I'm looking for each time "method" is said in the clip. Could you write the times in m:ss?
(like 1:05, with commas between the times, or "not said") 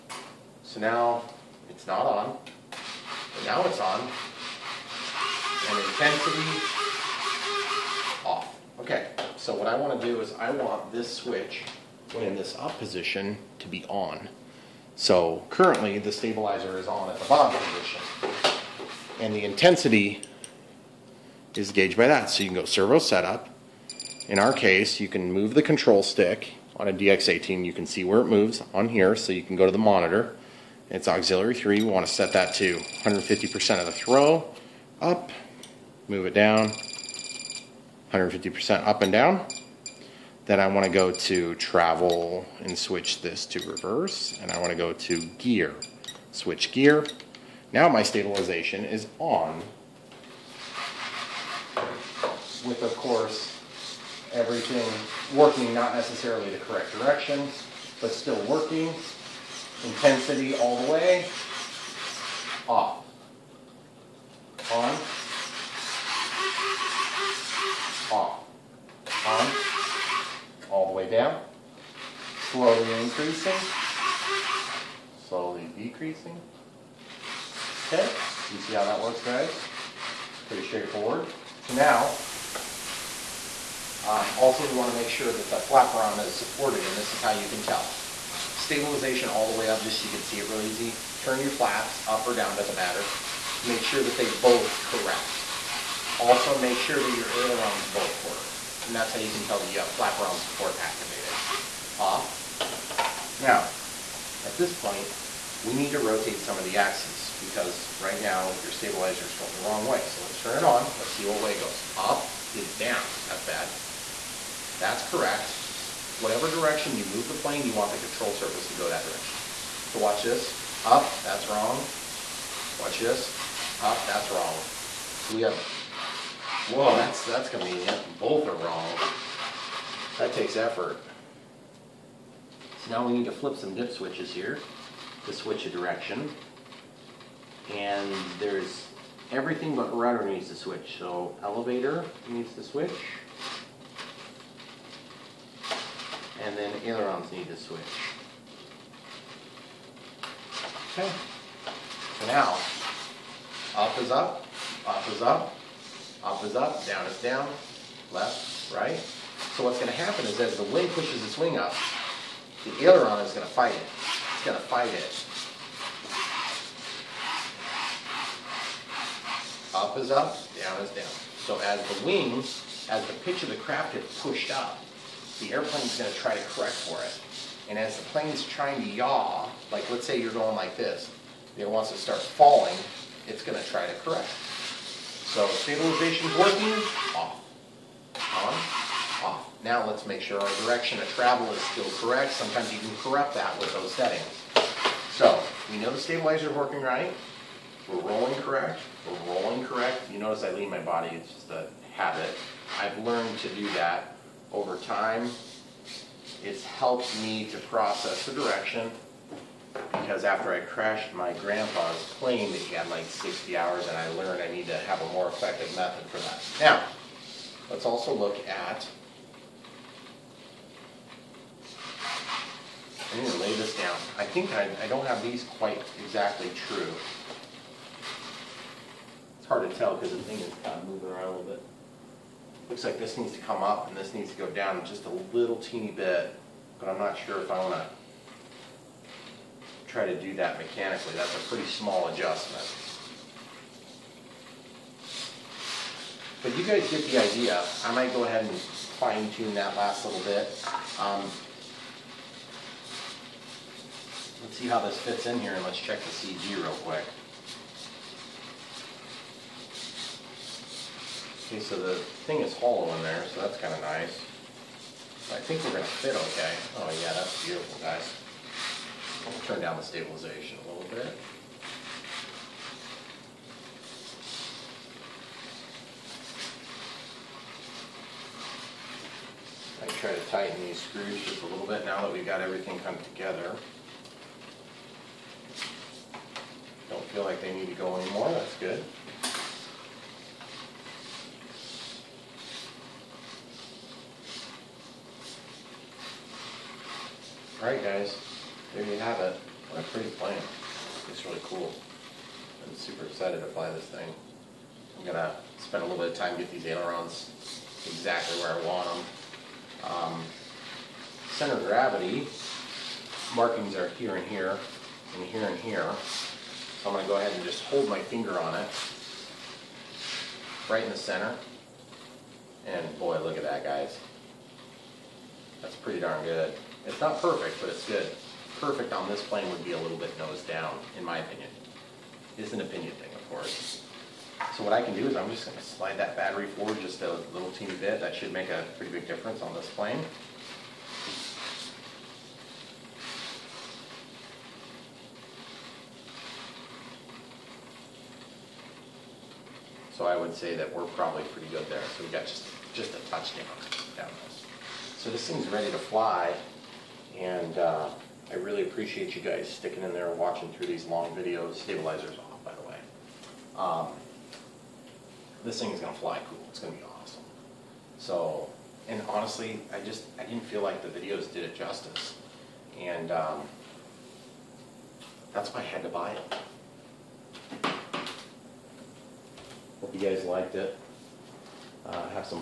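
3:35.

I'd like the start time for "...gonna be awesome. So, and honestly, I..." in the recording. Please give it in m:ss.
6:06.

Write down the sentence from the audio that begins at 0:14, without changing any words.
So currently the stabilizer is on at the bottom position.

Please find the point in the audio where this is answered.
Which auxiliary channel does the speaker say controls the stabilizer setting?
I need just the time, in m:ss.
0:31.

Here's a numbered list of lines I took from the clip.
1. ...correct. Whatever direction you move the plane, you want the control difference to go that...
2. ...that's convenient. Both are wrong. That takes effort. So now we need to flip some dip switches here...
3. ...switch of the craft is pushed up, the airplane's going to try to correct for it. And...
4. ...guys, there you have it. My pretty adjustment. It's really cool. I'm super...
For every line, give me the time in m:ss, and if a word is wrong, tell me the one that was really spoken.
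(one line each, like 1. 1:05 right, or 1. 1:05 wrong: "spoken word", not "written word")
1. 1:55 wrong: "surface", not "difference"
2. 2:07 right
3. 2:53 wrong: "pitch", not "switch"
4. 4:57 wrong: "plant", not "adjustment".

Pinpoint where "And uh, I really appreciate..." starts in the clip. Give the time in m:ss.
5:57.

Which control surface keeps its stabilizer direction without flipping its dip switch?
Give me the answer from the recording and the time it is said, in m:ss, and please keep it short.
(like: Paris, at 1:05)
Rudder, at 2:19.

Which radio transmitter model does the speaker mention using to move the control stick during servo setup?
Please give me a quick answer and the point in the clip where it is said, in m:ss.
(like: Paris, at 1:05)
DX18, at 0:26.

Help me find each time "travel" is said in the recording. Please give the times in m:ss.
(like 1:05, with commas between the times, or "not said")
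0:41, 3:11.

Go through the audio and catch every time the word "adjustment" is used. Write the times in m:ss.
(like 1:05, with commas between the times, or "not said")
4:02.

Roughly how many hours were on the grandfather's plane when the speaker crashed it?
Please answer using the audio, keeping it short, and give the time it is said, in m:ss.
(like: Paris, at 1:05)
60, at 3:33.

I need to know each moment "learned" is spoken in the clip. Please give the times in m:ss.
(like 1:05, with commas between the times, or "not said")
3:22, 3:34.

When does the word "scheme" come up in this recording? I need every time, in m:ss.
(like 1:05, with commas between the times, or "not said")
not said.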